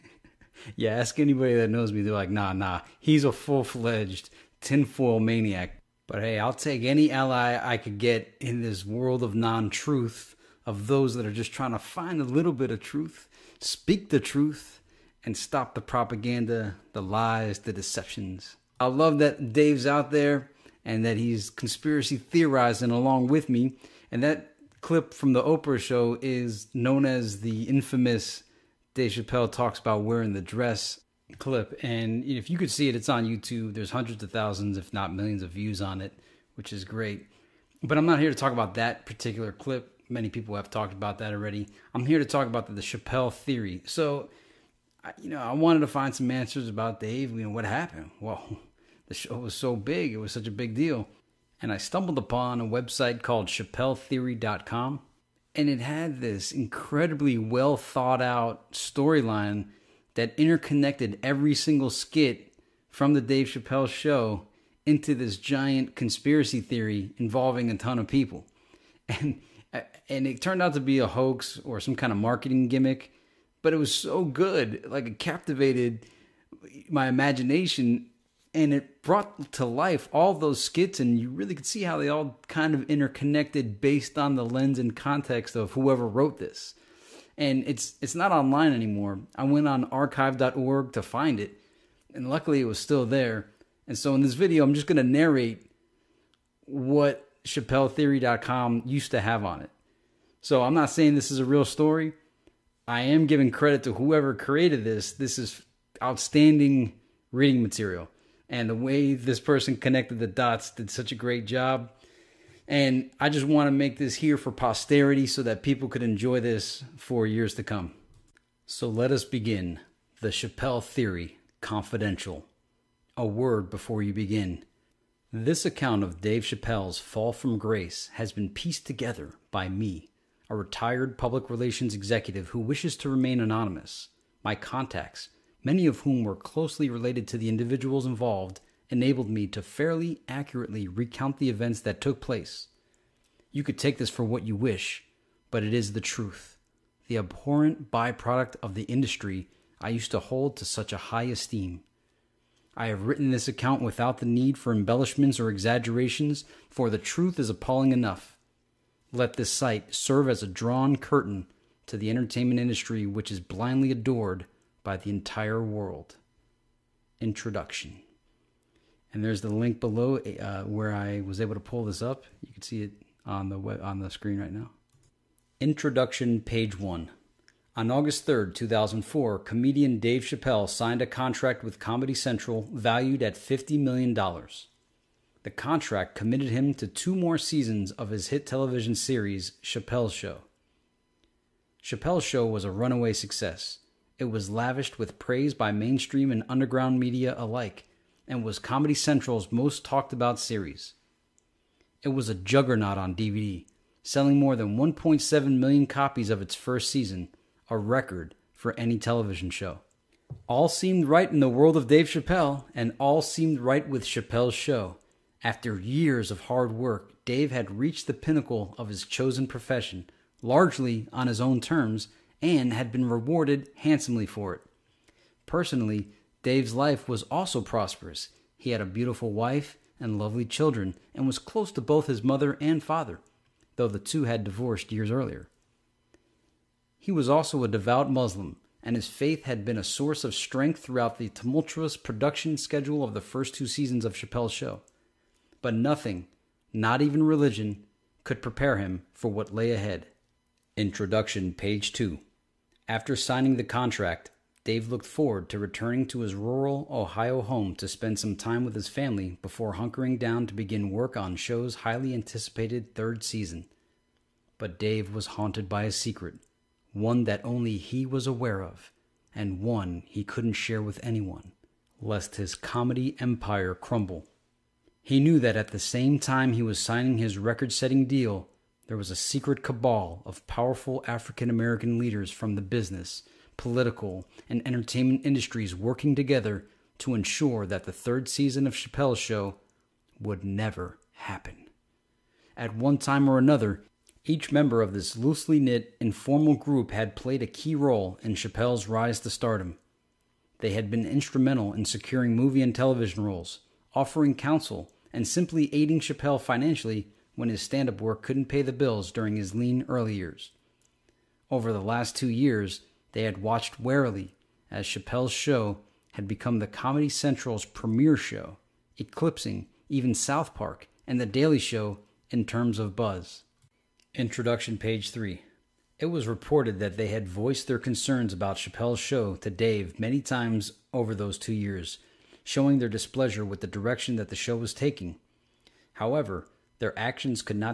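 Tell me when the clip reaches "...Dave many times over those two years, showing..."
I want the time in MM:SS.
05:29.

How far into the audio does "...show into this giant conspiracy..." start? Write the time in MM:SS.
01:03.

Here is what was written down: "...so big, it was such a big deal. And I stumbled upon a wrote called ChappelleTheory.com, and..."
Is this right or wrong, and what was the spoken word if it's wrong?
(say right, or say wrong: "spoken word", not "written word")
wrong: "website", not "wrote".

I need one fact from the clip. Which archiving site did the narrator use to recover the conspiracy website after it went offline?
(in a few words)
archive.org.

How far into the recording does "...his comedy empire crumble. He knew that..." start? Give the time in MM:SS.
04:32.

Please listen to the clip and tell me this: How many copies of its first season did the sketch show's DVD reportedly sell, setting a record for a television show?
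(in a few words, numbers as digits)
1.7 million.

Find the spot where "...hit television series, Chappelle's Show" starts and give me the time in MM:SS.
03:08.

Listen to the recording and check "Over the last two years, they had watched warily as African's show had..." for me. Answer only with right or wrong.
wrong.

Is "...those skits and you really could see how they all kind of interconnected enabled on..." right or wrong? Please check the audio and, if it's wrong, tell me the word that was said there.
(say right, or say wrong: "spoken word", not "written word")
wrong: "based", not "enabled".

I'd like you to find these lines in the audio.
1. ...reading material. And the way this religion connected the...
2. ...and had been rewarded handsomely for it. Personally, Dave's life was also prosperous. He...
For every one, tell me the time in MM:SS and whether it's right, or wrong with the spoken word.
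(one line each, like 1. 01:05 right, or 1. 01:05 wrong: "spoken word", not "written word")
1. 01:47 wrong: "person", not "religion"
2. 03:42 right.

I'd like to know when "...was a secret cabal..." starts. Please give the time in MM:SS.
04:38.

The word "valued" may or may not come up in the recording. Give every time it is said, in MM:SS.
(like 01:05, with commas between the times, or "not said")
03:02.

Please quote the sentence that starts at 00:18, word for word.
I love that Dave's out there and that he's conspiracy theorizing along with me.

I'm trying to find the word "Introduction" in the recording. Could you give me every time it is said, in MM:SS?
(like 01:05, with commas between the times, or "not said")
02:47, 02:55, 04:10, 05:24.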